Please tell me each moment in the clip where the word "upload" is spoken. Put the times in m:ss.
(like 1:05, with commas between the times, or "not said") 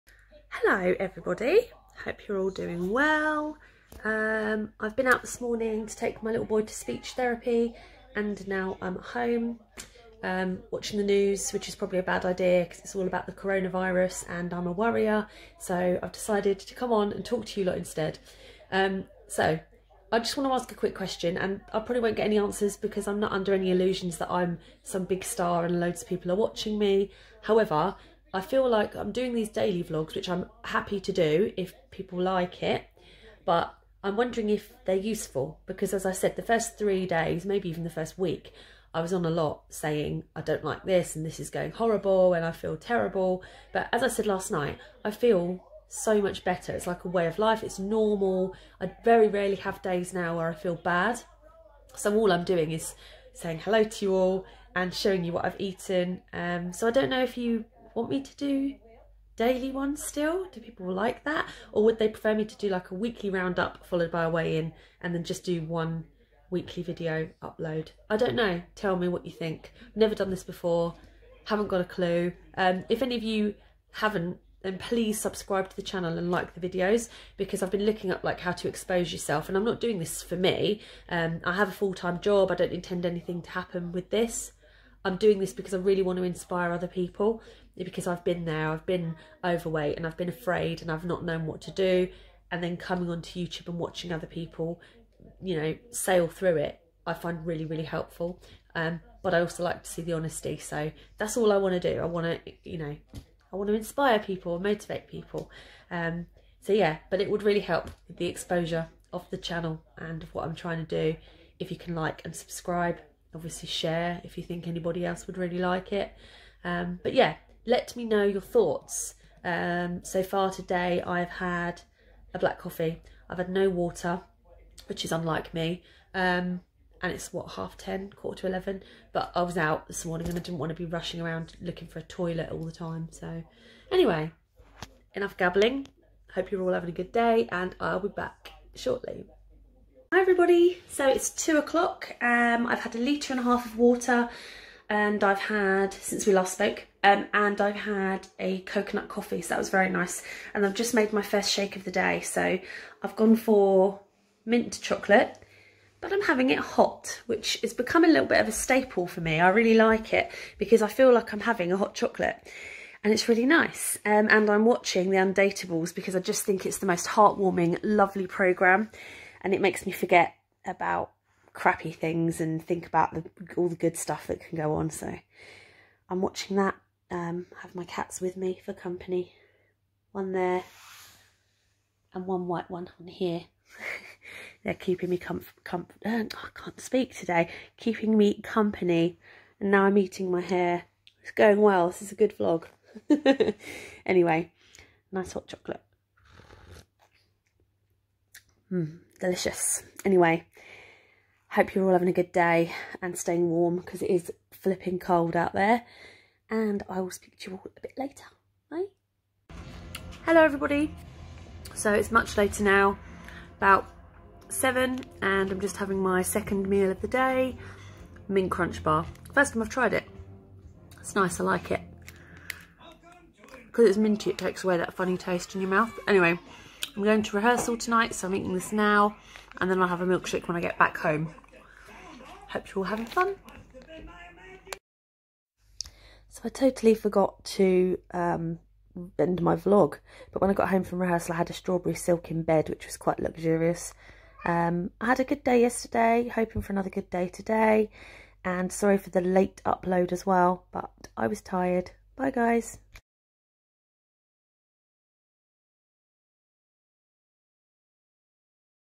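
1:07, 4:09.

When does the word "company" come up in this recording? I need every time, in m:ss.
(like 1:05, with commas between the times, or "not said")
2:58, 3:08.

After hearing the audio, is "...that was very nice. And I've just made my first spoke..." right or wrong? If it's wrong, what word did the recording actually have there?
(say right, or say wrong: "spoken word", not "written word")
wrong: "shake", not "spoke".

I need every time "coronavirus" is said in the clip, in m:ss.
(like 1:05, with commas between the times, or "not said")
0:13.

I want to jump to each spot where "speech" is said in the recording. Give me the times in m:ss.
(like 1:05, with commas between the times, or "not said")
0:06.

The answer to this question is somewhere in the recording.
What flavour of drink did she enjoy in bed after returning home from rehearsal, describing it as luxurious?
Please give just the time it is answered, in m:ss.
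4:01.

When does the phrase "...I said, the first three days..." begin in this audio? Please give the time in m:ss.
0:36.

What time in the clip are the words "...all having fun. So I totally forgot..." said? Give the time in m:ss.
3:52.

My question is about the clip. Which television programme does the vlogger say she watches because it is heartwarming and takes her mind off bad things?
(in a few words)
The Undateables.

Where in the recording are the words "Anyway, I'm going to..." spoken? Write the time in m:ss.
3:46.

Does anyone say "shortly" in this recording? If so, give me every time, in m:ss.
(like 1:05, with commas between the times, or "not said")
2:18.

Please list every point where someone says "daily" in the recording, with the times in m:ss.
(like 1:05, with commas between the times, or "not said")
0:29, 0:59.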